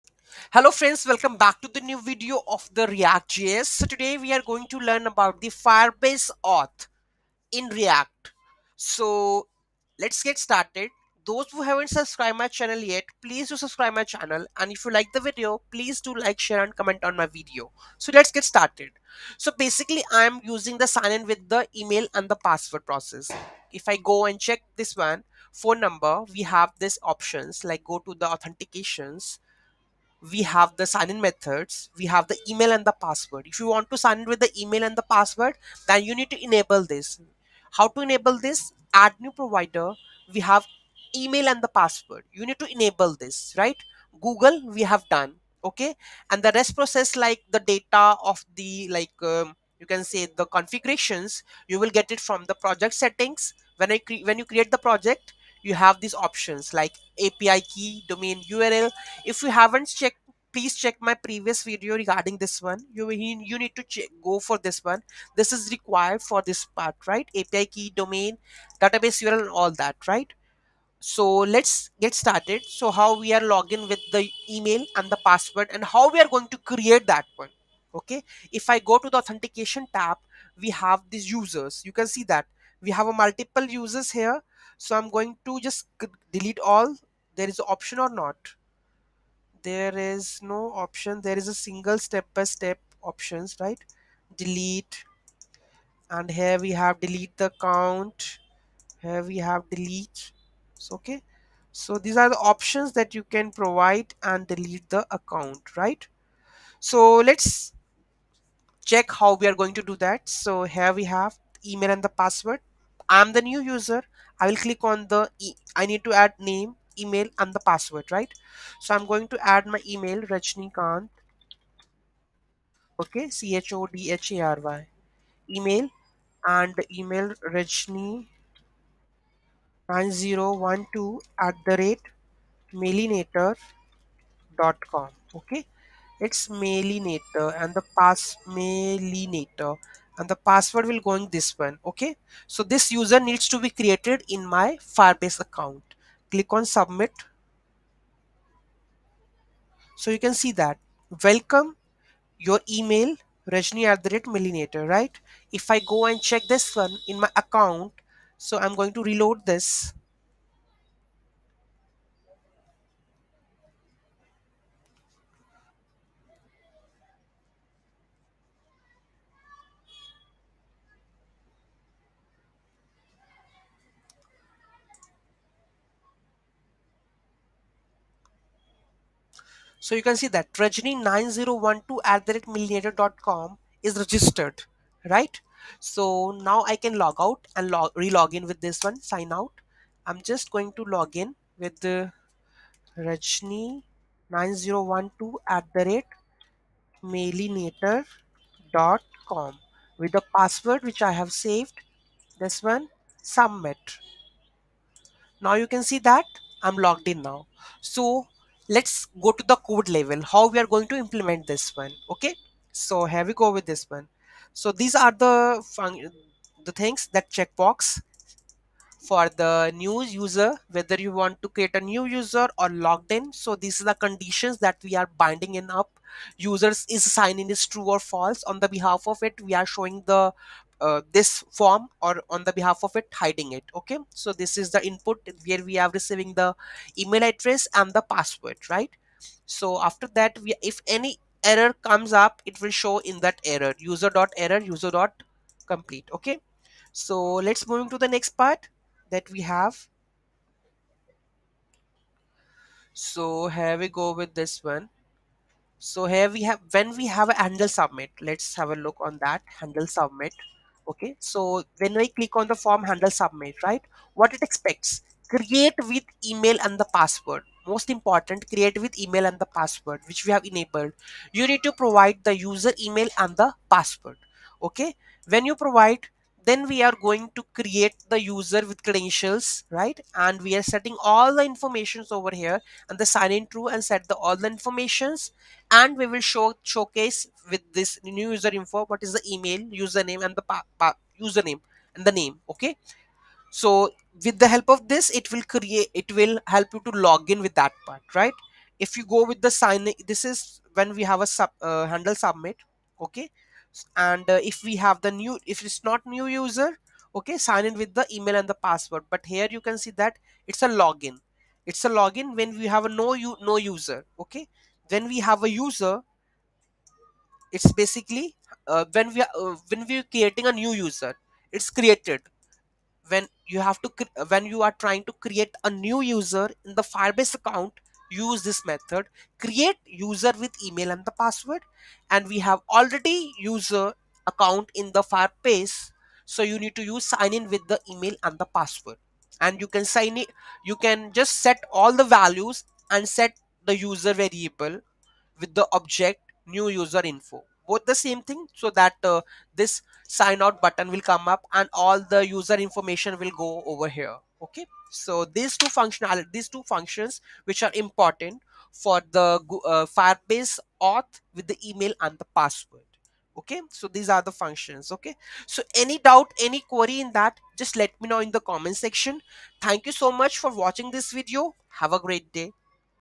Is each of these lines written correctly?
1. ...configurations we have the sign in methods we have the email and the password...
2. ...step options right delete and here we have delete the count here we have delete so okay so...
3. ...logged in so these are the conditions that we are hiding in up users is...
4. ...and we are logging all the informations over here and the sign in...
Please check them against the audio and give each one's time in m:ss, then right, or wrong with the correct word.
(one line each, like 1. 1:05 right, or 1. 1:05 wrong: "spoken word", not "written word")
1. 0:28 wrong: "authentications", not "configurations"
2. 1:32 right
3. 3:42 wrong: "binding", not "hiding"
4. 4:40 wrong: "setting", not "logging".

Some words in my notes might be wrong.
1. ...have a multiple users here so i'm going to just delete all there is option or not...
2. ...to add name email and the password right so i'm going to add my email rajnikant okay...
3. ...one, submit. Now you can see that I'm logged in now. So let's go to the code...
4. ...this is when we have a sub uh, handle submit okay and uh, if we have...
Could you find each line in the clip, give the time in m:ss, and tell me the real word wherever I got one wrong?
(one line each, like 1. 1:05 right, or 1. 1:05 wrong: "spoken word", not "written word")
1. 1:22 right
2. 1:56 right
3. 3:22 right
4. 5:00 right.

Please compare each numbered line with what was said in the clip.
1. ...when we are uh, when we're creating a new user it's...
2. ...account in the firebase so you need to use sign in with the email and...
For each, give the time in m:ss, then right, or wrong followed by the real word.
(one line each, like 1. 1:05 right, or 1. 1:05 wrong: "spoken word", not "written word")
1. 5:18 right
2. 5:34 right.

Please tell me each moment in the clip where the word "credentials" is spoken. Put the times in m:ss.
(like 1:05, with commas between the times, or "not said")
4:38.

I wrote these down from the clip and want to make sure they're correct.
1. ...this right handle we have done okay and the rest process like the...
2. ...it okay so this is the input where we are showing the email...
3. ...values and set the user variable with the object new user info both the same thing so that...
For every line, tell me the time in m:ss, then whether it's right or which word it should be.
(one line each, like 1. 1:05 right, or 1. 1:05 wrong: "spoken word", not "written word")
1. 0:43 wrong: "google", not "handle"
2. 3:53 wrong: "receiving", not "showing"
3. 5:42 right.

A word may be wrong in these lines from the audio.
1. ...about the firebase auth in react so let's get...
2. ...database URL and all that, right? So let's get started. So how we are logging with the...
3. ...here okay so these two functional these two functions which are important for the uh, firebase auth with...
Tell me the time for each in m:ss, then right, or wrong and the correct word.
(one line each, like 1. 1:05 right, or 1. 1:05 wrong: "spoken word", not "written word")
1. 0:05 right
2. 1:08 right
3. 5:53 right.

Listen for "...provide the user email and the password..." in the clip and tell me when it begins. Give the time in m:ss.
4:31.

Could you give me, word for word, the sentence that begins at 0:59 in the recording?
If you haven't checked, please check my previous video regarding this one.